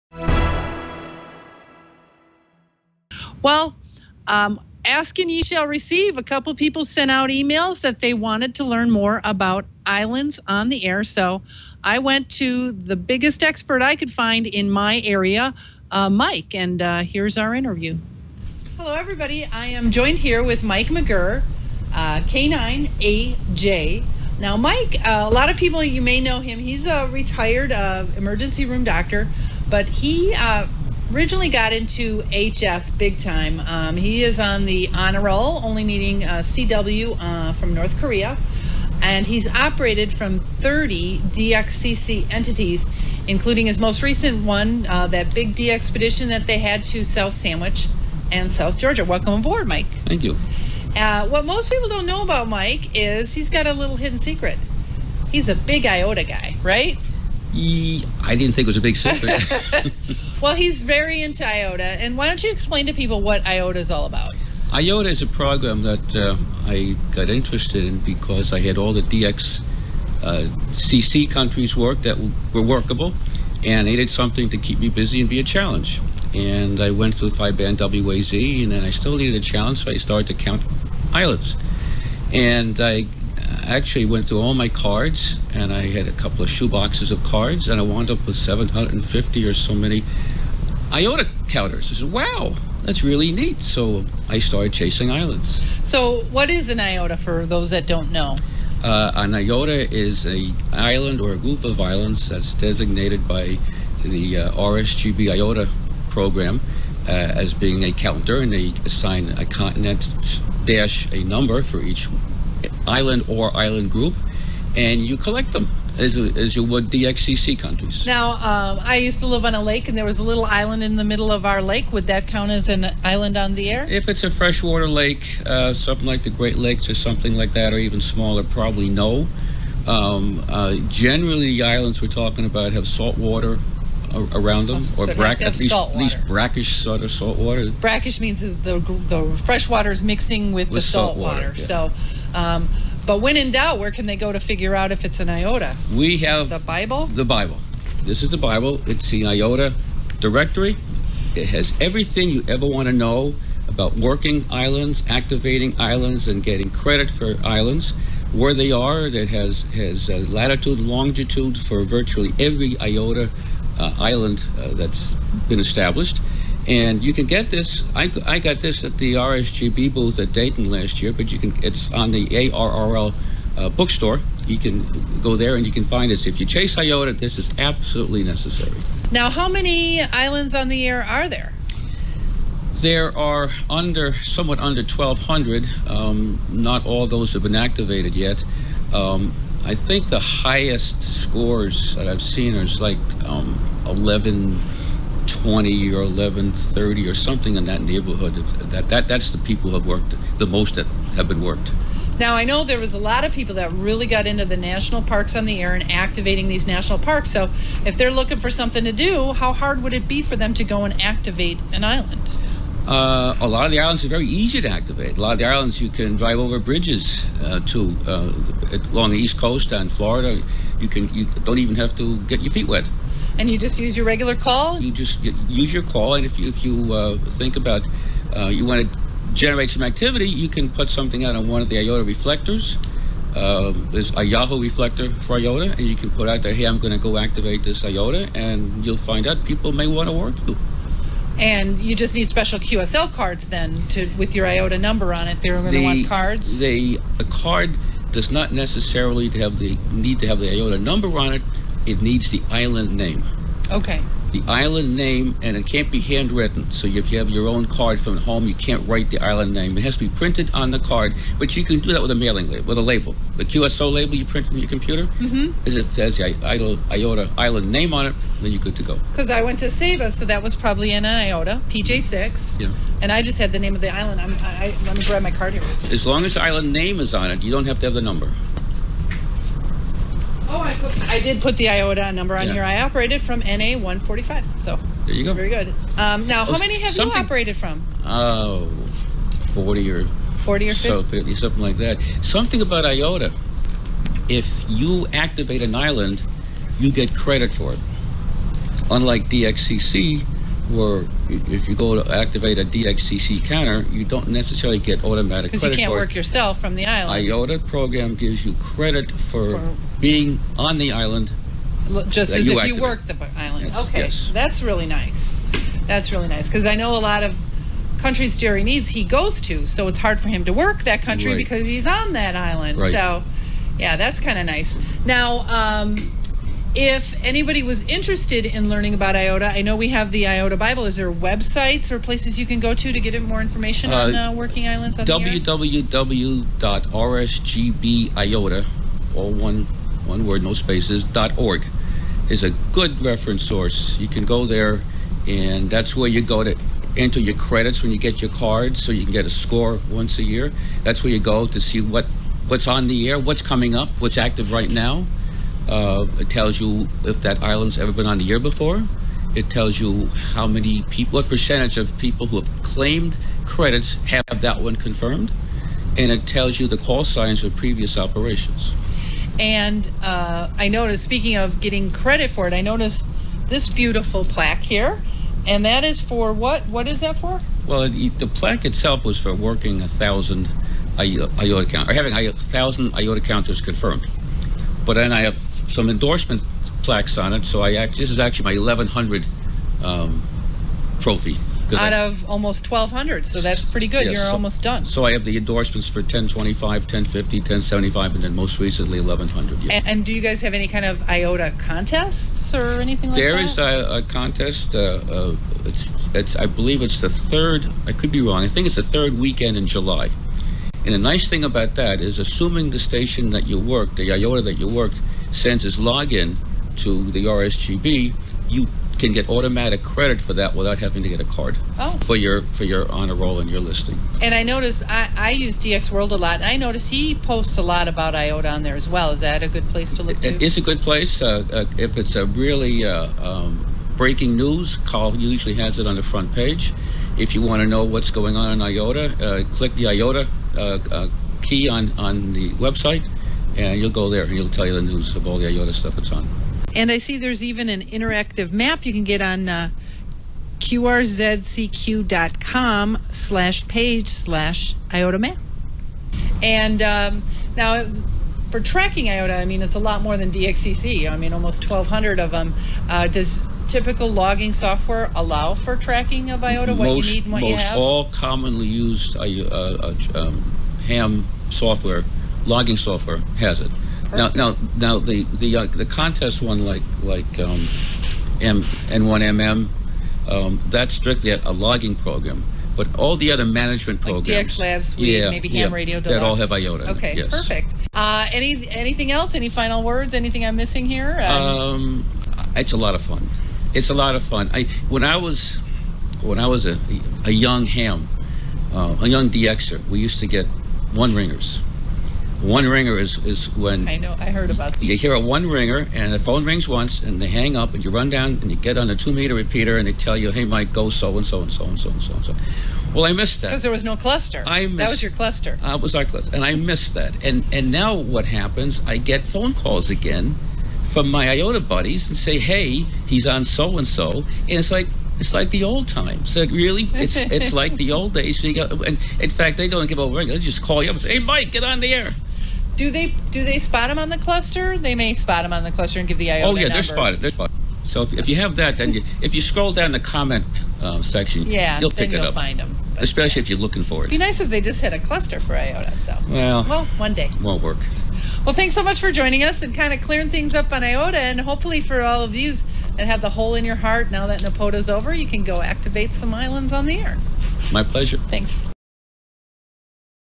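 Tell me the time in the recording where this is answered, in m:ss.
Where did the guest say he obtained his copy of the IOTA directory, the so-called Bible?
2:50.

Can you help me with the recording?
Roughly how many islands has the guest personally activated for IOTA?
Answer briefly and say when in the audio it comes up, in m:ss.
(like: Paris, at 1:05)
40 or 50, at 4:50.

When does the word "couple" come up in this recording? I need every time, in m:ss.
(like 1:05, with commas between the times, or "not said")
0:06, 1:26.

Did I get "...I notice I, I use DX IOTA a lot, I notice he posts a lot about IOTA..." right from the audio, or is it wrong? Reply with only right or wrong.
wrong.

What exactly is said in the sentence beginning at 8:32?
Well, I missed that because there was no cluster.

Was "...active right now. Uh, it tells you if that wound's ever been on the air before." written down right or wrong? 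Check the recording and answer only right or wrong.
wrong.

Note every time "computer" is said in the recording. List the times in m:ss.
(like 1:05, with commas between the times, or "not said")
4:24.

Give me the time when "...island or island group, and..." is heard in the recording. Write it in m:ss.
1:52.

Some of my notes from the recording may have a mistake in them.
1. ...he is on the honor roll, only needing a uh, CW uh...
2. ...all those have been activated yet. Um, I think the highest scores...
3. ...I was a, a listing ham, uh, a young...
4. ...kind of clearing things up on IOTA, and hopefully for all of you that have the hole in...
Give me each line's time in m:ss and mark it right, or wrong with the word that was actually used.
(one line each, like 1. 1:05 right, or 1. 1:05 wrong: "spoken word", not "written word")
1. 0:33 right
2. 3:06 right
3. 8:16 wrong: "young", not "listing"
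4. 9:09 right.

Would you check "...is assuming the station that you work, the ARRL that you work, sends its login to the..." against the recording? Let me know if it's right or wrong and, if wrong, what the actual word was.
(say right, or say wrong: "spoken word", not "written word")
wrong: "IOTA", not "ARRL".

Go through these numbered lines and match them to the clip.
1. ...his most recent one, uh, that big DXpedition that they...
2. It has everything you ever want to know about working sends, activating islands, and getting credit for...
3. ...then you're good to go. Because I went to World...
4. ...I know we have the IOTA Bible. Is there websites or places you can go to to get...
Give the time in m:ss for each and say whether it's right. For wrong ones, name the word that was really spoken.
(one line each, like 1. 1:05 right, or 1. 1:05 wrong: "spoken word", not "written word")
1. 0:43 right
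2. 2:31 wrong: "islands", not "sends"
3. 4:28 wrong: "Saba", not "World"
4. 5:29 right.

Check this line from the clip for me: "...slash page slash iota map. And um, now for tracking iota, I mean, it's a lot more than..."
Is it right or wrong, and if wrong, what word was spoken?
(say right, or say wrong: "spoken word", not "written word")
right.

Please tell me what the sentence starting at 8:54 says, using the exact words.
They may spot them on the cluster and give the IOTA Oh yeah, number.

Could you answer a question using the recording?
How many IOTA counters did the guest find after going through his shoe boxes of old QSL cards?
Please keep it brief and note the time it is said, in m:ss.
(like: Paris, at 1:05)
750, at 1:28.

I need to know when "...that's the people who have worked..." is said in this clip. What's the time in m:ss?
3:19.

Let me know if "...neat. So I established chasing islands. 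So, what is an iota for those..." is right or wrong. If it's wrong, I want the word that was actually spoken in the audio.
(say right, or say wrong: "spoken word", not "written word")
wrong: "started", not "established".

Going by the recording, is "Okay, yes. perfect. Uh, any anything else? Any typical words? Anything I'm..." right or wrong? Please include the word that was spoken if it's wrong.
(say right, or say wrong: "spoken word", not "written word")
wrong: "final", not "typical".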